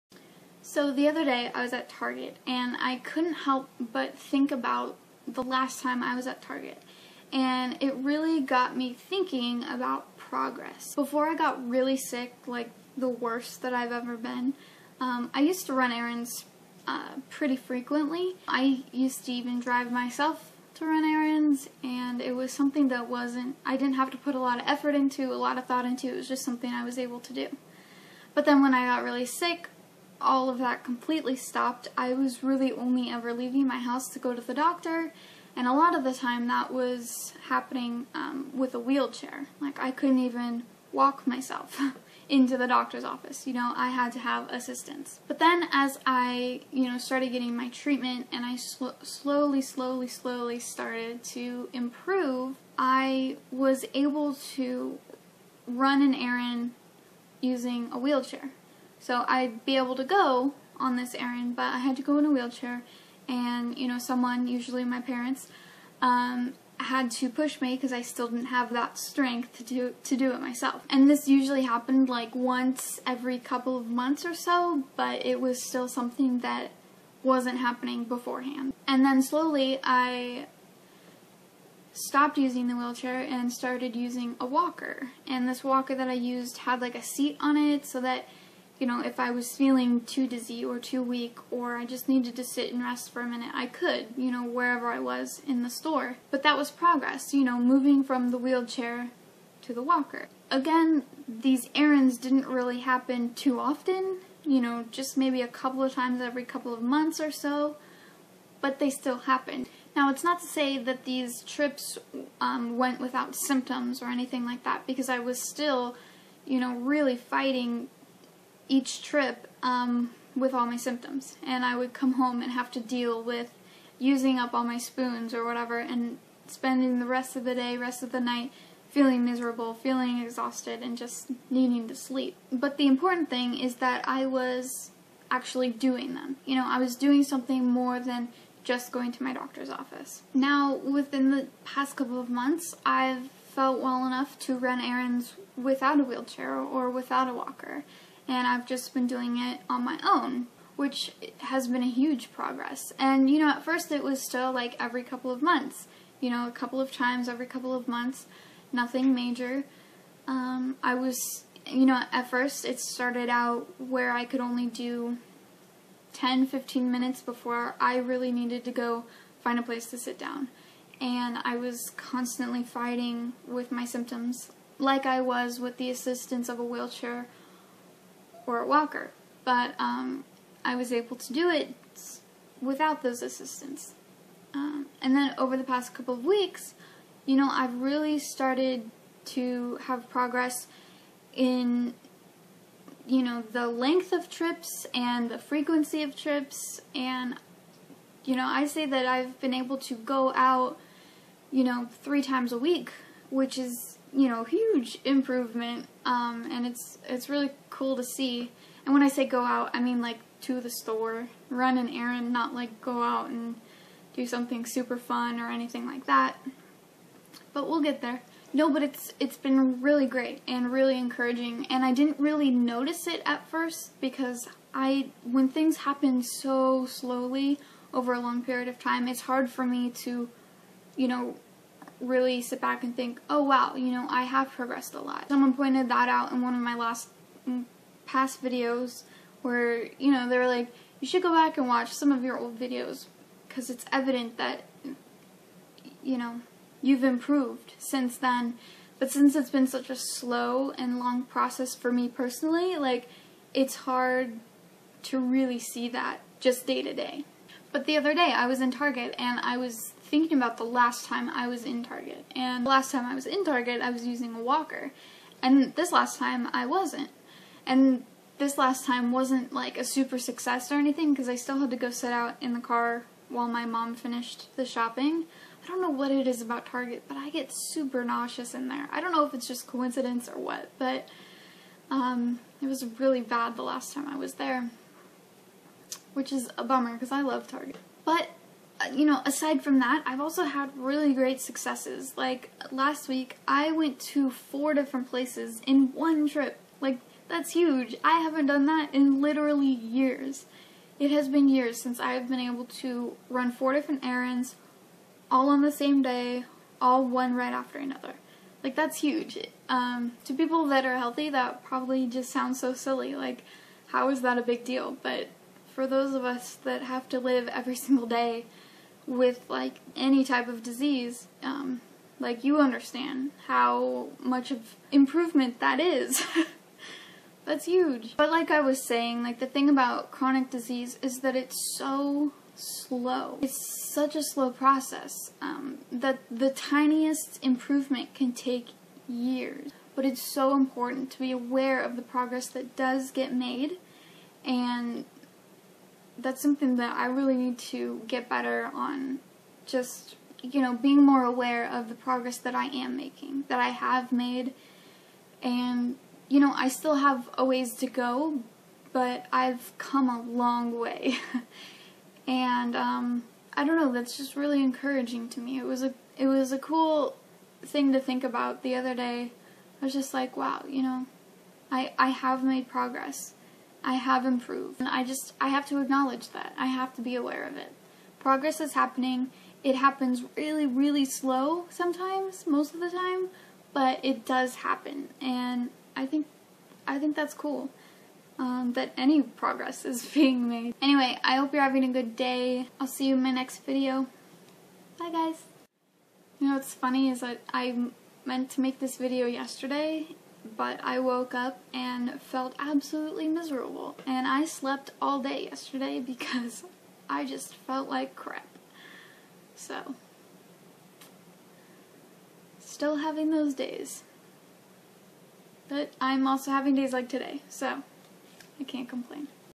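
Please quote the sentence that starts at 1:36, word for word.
But that was progress, you know, moving from the wheelchair to the walker.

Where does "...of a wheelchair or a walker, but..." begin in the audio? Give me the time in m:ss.
2:56.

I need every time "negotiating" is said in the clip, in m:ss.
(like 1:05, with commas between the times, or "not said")
not said.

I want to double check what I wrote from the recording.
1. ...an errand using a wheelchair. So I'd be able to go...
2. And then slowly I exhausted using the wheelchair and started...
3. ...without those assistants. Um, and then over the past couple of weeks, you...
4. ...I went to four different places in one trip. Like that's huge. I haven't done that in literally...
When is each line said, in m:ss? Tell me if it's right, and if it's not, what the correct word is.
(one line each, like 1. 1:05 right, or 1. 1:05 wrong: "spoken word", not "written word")
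1. 0:56 right
2. 1:18 wrong: "stopped", not "exhausted"
3. 3:02 right
4. 4:53 right.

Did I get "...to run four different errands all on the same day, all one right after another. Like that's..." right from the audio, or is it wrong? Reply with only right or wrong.
right.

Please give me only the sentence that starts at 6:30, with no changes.
Anyway, I hope you're having a good day.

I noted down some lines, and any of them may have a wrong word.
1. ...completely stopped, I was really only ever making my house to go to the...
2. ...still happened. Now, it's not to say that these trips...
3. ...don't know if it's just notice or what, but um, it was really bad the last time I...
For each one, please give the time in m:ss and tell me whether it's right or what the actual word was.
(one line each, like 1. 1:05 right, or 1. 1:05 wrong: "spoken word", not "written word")
1. 0:30 wrong: "leaving", not "making"
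2. 1:48 right
3. 4:39 wrong: "coincidence", not "notice".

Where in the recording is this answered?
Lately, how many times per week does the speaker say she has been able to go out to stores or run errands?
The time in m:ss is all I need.
3:22.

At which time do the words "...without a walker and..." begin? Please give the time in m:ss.
2:26.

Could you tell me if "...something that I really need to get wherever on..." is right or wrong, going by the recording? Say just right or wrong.
wrong.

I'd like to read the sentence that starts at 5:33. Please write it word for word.
It's such a slow process um, that the tiniest improvement can take years.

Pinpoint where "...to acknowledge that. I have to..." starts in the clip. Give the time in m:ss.
6:15.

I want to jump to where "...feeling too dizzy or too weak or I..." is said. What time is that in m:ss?
1:29.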